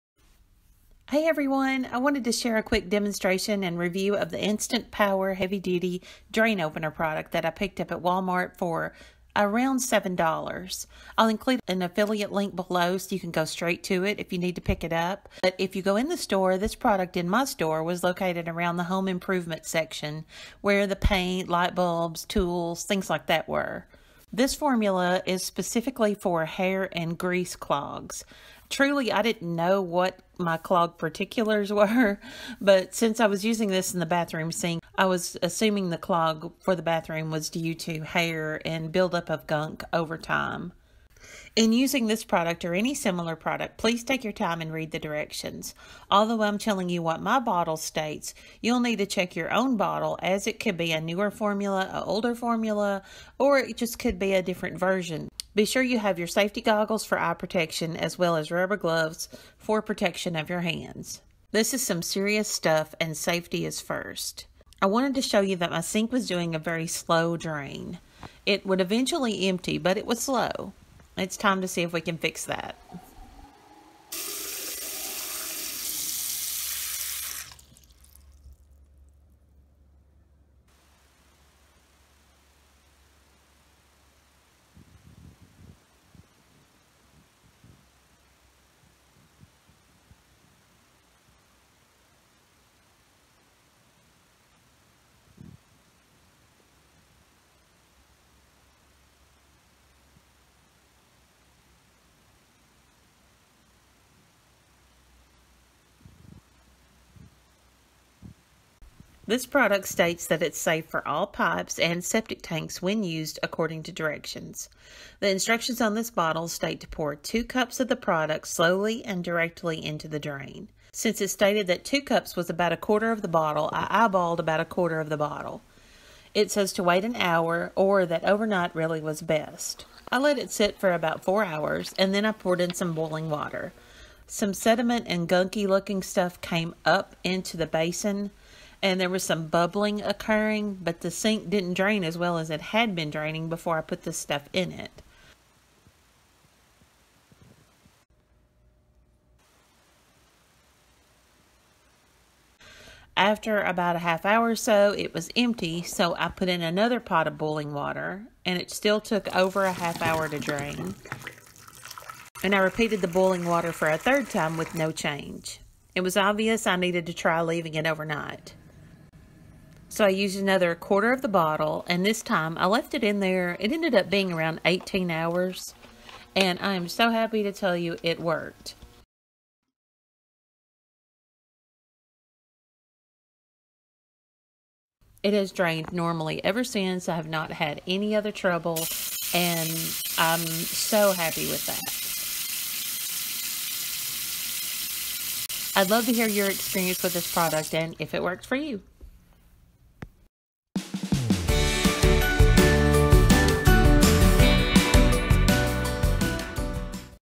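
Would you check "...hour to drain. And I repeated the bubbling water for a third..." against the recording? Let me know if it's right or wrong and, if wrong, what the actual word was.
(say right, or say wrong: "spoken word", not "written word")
wrong: "boiling", not "bubbling".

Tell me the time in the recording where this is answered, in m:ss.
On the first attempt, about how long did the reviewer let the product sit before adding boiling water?
2:11.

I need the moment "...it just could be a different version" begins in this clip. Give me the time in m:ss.
0:53.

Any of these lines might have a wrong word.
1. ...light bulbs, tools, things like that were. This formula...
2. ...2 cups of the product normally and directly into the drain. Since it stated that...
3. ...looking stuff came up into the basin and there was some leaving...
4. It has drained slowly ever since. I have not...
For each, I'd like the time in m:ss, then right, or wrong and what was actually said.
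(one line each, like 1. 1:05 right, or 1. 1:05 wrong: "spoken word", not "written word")
1. 0:21 right
2. 1:57 wrong: "slowly", not "normally"
3. 2:15 wrong: "bubbling", not "leaving"
4. 3:05 wrong: "normally", not "slowly".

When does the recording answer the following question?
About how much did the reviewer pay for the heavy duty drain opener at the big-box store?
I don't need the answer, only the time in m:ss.
0:09.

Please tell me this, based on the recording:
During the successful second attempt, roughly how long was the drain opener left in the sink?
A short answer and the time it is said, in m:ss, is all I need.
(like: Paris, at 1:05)
18 hours, at 2:54.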